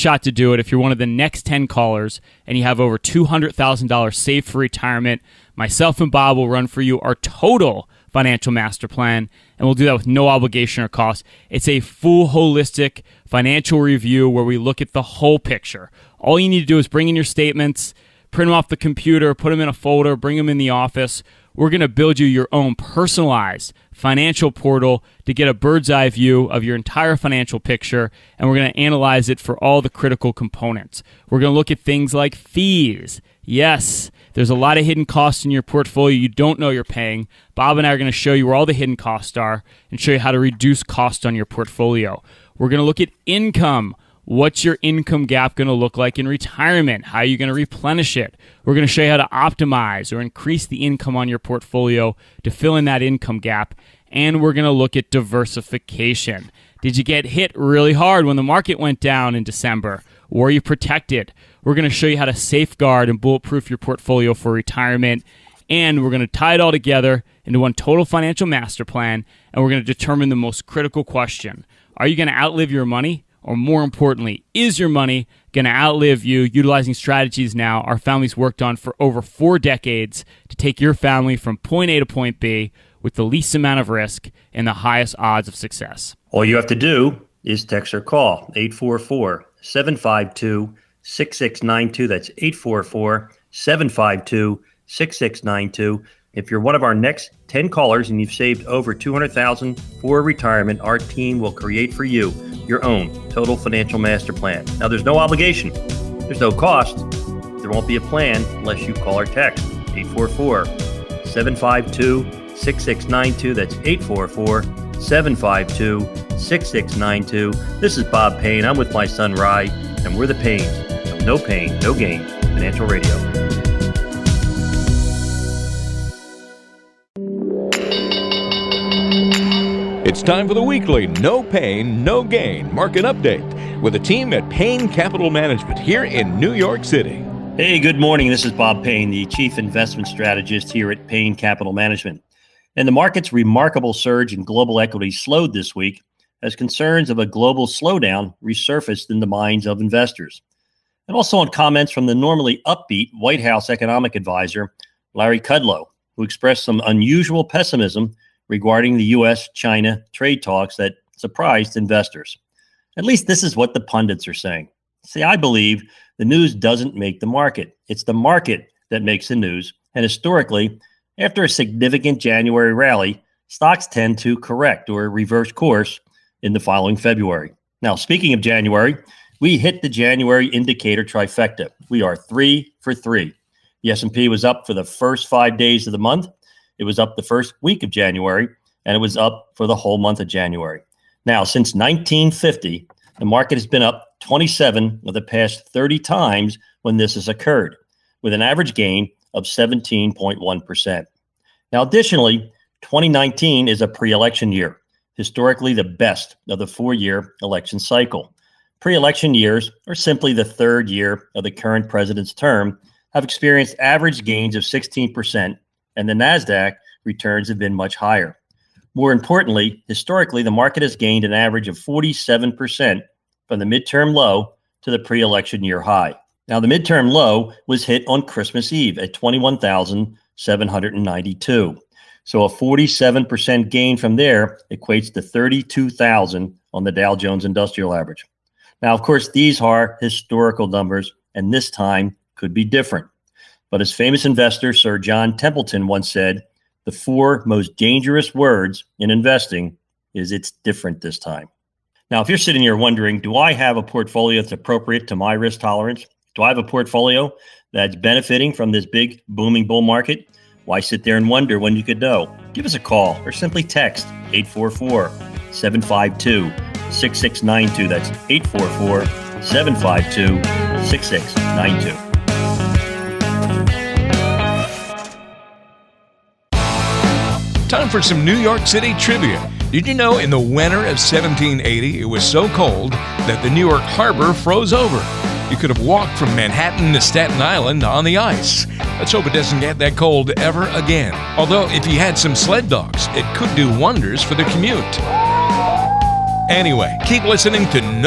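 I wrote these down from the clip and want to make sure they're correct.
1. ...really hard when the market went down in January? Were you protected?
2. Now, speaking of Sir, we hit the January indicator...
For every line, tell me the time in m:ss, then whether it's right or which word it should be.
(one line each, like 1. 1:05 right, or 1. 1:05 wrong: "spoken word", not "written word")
1. 0:57 wrong: "December", not "January"
2. 2:57 wrong: "January", not "Sir".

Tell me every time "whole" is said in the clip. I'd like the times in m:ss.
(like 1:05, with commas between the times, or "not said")
0:15, 3:09.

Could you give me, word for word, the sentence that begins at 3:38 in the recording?
More importantly, historically, the market has gained an average of 47% from the midterm low to the pre election year high.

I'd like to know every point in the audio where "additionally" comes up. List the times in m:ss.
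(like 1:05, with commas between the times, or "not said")
3:21.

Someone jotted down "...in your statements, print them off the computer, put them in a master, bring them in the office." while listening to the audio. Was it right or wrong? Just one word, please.
wrong.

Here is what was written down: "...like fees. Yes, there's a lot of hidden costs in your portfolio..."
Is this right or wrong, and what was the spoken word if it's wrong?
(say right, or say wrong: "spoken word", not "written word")
right.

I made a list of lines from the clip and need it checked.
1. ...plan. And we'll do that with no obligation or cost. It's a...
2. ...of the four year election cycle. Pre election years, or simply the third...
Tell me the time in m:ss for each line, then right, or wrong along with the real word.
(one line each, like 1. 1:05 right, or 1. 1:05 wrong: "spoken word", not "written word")
1. 0:08 right
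2. 3:26 right.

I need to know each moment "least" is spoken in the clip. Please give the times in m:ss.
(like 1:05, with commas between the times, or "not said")
1:23, 2:43.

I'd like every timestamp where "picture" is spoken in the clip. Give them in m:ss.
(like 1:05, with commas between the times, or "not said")
0:15, 0:27.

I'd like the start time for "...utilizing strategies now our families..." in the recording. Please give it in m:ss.
1:16.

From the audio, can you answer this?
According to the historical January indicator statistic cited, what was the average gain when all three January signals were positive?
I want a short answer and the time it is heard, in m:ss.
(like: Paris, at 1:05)
17.1%, at 3:19.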